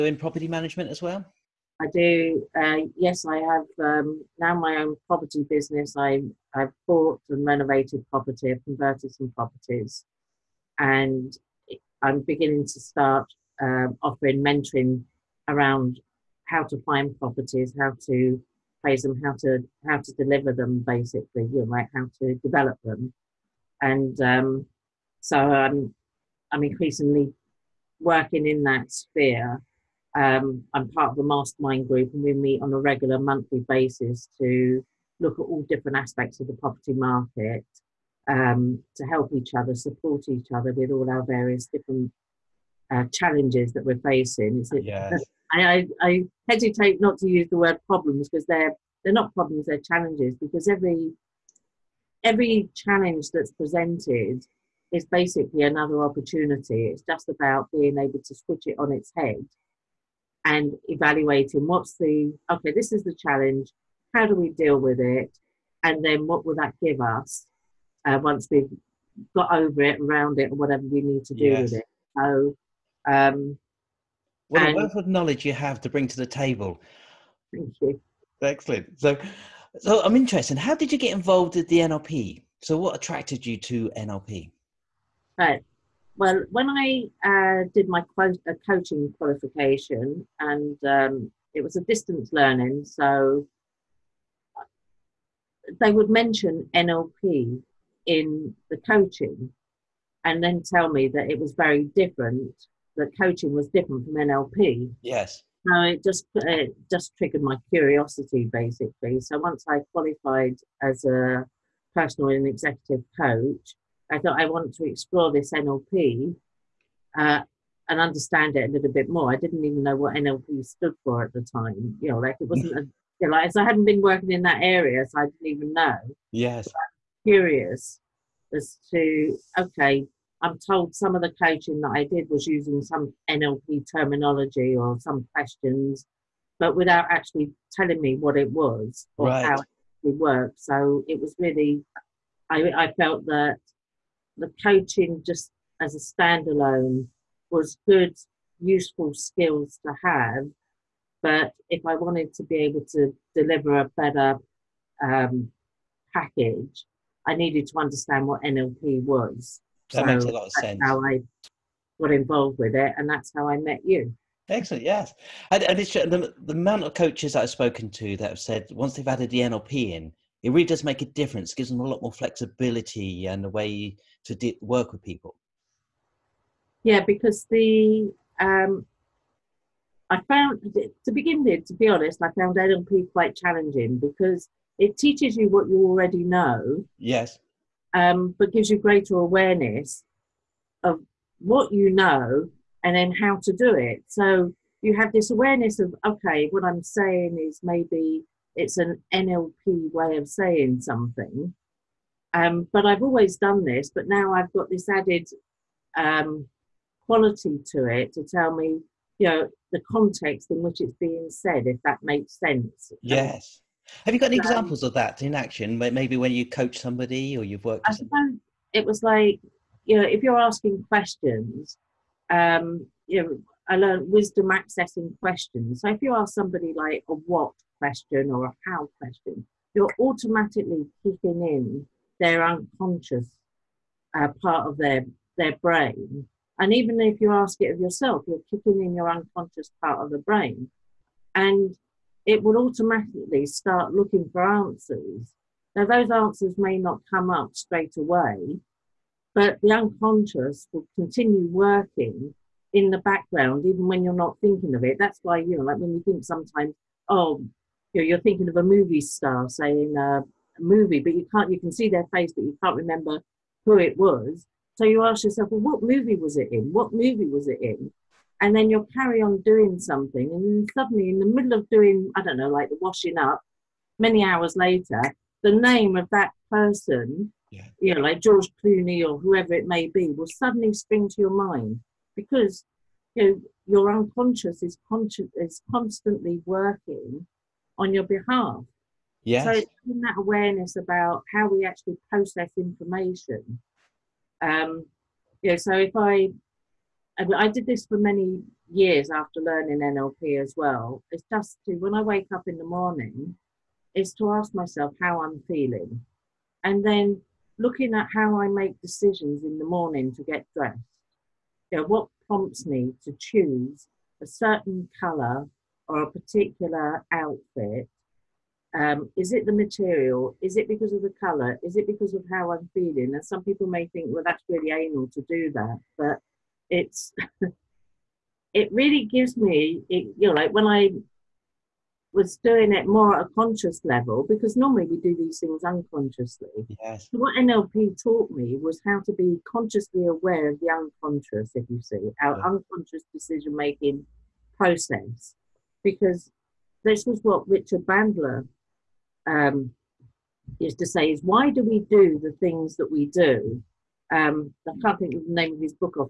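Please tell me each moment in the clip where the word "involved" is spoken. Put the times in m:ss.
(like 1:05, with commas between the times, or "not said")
1:21, 2:42.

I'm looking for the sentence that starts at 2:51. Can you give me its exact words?
It gives them a lot more flexibility and a way to de- work with people.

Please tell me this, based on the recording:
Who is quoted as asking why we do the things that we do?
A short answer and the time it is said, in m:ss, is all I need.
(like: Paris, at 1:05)
Richard Bandler, at 5:47.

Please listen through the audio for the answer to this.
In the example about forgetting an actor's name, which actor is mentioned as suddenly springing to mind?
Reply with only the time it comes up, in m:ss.
4:38.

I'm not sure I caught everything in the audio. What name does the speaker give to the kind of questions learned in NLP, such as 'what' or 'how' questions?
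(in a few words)
wisdom accessing questions.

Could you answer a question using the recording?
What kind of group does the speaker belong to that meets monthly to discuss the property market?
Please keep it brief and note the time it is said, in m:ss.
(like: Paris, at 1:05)
mastermind group, at 0:31.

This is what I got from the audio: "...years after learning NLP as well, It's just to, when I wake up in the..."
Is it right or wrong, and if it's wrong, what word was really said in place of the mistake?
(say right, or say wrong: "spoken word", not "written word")
right.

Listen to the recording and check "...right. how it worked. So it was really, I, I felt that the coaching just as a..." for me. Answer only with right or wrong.
right.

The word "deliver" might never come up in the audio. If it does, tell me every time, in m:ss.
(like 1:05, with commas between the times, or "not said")
0:20, 2:33.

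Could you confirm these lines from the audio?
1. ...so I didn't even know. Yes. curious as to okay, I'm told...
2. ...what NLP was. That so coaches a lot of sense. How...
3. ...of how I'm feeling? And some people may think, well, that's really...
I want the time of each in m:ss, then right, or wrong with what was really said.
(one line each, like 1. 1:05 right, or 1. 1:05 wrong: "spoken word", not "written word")
1. 2:05 right
2. 2:38 wrong: "makes", not "coaches"
3. 5:22 right.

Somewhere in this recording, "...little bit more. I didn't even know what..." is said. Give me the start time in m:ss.
1:58.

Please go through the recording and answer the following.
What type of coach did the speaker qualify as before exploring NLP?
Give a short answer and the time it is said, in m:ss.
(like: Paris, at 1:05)
personal and executive coach, at 1:51.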